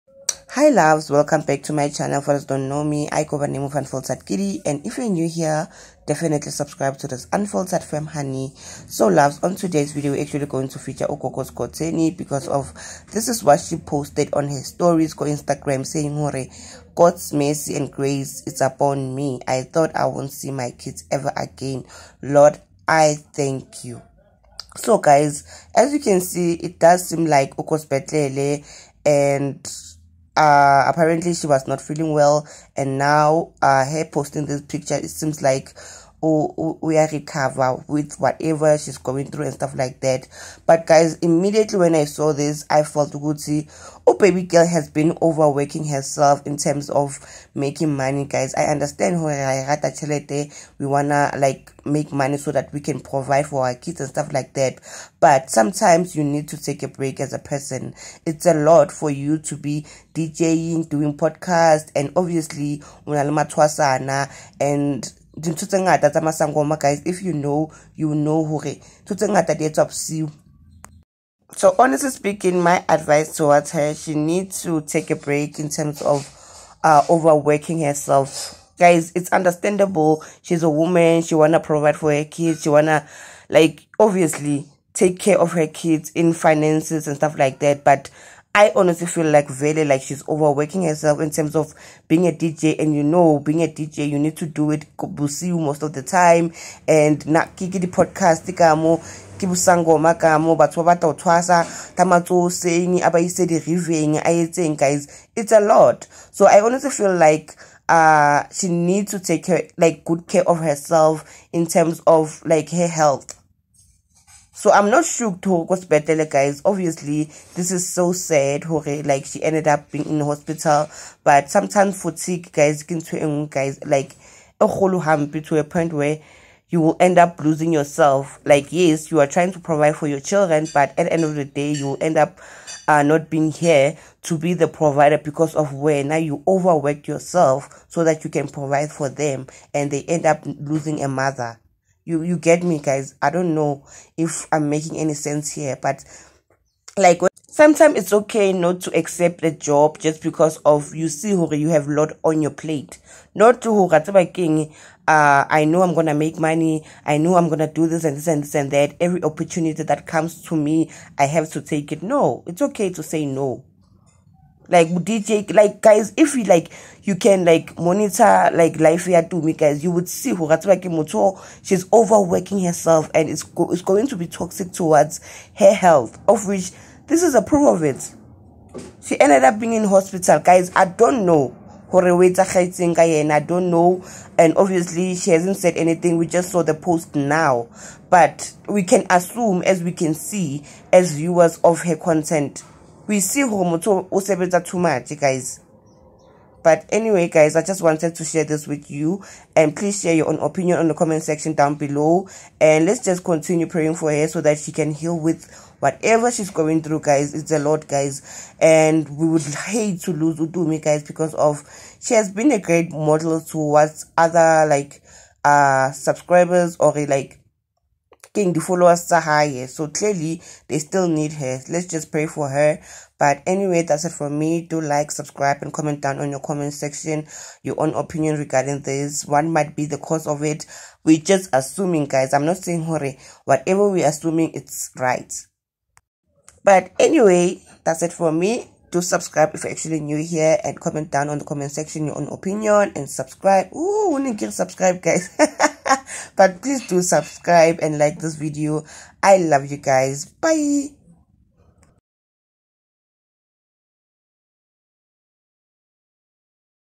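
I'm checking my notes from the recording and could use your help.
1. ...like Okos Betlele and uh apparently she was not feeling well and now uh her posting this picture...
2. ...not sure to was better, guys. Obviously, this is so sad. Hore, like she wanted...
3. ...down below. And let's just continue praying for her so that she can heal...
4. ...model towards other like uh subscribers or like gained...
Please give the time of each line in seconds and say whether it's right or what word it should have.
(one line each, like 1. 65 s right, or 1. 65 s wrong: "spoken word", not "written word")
1. 27 s right
2. 114 s wrong: "ended", not "wanted"
3. 201 s right
4. 212 s right.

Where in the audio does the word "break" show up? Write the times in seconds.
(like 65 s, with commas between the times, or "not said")
56 s, 75 s.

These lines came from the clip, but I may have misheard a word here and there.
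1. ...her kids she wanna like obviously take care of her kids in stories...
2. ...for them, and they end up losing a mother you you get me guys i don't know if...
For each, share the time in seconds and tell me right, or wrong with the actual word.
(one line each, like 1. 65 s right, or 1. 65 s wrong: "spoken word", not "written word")
1. 82 s wrong: "finances", not "stories"
2. 138 s right.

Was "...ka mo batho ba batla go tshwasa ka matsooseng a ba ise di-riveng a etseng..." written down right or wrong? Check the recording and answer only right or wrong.
right.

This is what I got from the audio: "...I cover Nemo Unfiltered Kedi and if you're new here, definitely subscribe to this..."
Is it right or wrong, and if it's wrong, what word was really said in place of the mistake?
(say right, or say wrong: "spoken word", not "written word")
right.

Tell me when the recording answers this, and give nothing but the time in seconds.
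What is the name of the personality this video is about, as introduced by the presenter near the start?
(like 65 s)
11 s.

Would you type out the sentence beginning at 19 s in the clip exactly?
I thought I won't see my kids ever again.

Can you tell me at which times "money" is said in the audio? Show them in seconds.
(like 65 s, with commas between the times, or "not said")
47 s, 52 s, 156 s.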